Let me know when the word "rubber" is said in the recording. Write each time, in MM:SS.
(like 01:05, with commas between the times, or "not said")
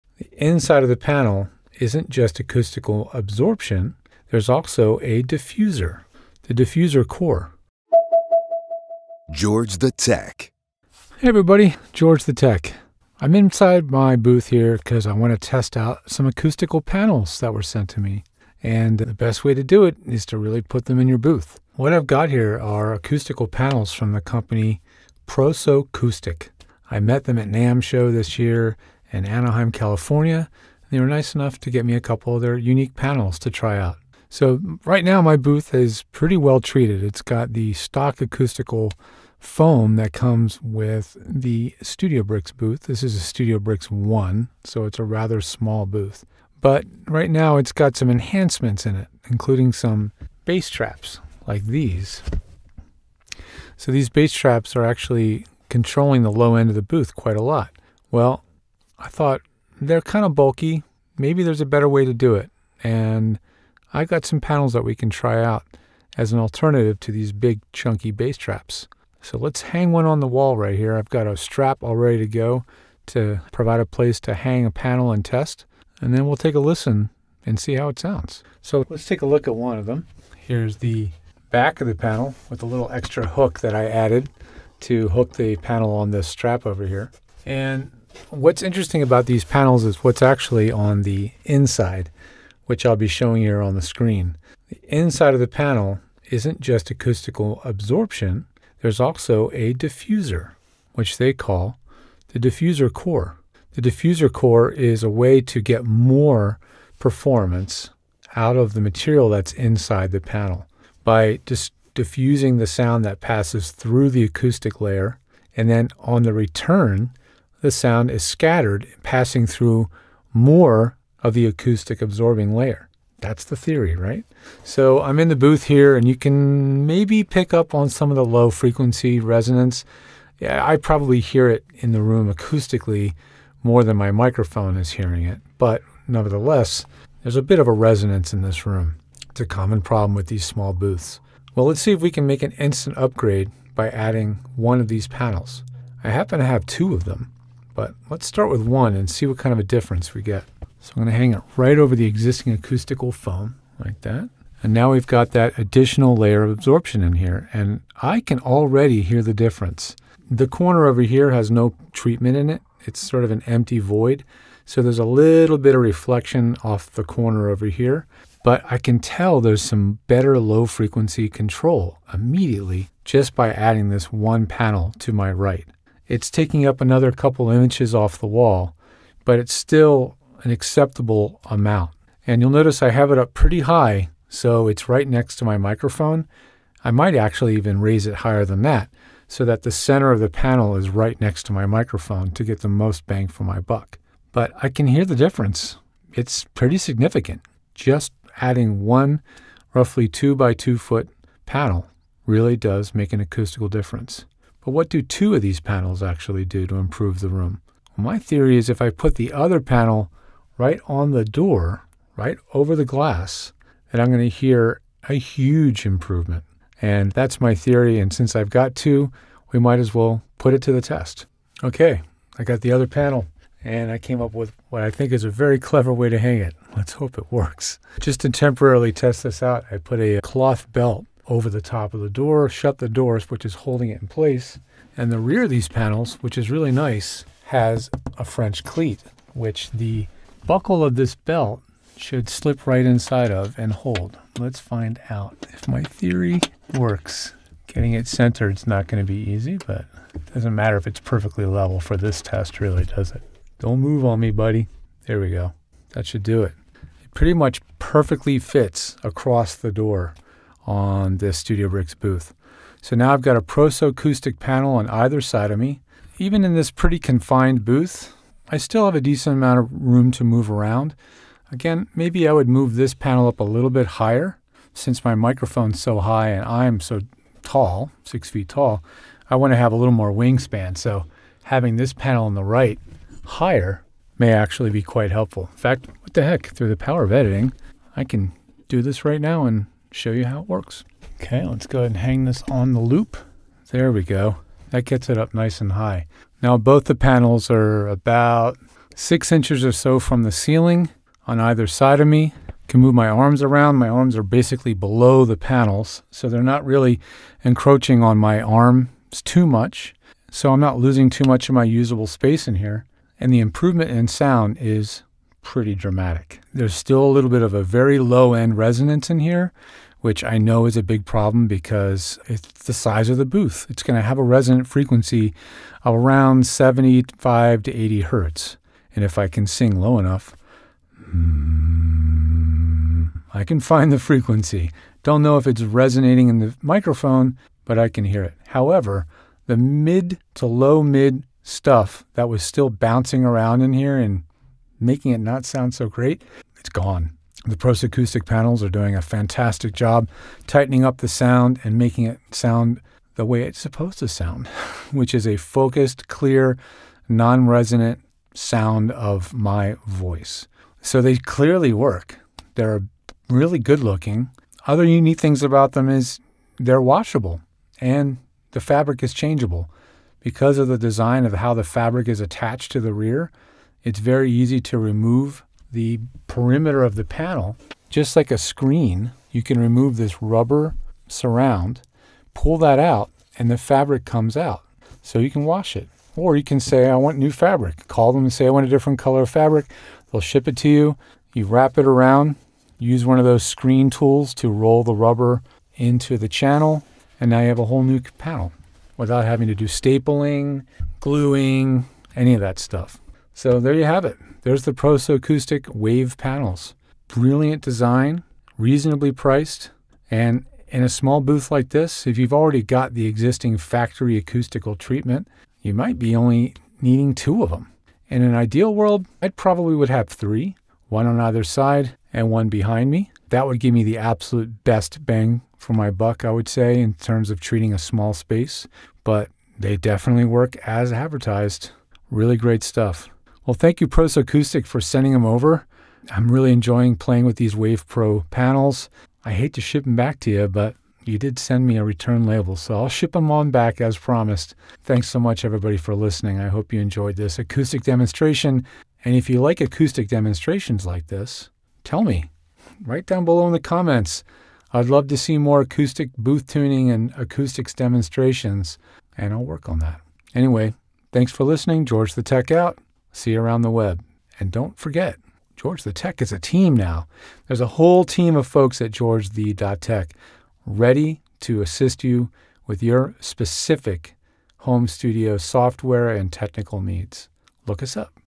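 06:20, 06:34.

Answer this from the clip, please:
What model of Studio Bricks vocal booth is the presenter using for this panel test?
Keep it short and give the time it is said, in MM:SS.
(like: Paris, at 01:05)
Studio Bricks 1, at 00:43.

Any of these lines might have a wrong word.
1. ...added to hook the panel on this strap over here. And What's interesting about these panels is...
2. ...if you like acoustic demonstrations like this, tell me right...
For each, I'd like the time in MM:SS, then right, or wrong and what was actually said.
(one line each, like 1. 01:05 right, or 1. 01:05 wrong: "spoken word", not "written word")
1. 01:23 right
2. 07:29 right.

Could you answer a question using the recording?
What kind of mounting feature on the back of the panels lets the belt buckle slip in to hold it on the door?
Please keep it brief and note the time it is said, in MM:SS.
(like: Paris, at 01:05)
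French cleat, at 03:58.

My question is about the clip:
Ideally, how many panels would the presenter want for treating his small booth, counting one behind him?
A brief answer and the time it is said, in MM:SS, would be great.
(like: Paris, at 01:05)
3, at 07:00.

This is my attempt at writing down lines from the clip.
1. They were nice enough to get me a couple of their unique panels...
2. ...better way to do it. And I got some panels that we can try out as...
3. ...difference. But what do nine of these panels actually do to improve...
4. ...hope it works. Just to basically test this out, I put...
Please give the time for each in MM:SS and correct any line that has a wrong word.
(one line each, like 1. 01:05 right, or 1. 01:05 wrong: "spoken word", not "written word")
1. 00:30 right
2. 01:01 right
3. 03:23 wrong: "two", not "nine"
4. 03:46 wrong: "temporarily", not "basically".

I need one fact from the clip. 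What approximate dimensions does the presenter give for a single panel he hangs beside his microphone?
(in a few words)
2 by 2 feet.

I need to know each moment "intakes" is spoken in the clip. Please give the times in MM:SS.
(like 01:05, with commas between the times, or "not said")
not said.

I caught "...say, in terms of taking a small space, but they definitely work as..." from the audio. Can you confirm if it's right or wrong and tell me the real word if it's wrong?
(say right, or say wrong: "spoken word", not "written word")
wrong: "treating", not "taking".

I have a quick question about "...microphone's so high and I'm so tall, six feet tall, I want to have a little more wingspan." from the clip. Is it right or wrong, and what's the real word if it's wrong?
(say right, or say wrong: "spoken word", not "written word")
right.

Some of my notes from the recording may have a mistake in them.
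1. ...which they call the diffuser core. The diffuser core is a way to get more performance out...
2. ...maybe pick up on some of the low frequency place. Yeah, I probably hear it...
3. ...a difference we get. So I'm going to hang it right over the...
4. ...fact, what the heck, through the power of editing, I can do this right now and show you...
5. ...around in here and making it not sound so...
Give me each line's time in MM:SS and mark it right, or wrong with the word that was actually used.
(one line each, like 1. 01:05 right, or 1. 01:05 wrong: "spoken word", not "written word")
1. 01:40 right
2. 02:06 wrong: "resonance", not "place"
3. 02:29 right
4. 04:45 right
5. 05:43 right.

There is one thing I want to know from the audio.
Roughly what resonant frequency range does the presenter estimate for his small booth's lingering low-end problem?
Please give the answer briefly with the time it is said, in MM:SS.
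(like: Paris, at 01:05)
75 to 80 Hz, at 05:26.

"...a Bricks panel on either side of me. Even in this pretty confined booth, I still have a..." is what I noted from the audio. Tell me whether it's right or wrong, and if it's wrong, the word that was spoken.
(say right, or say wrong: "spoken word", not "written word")
wrong: "ProSoCoustic", not "Bricks".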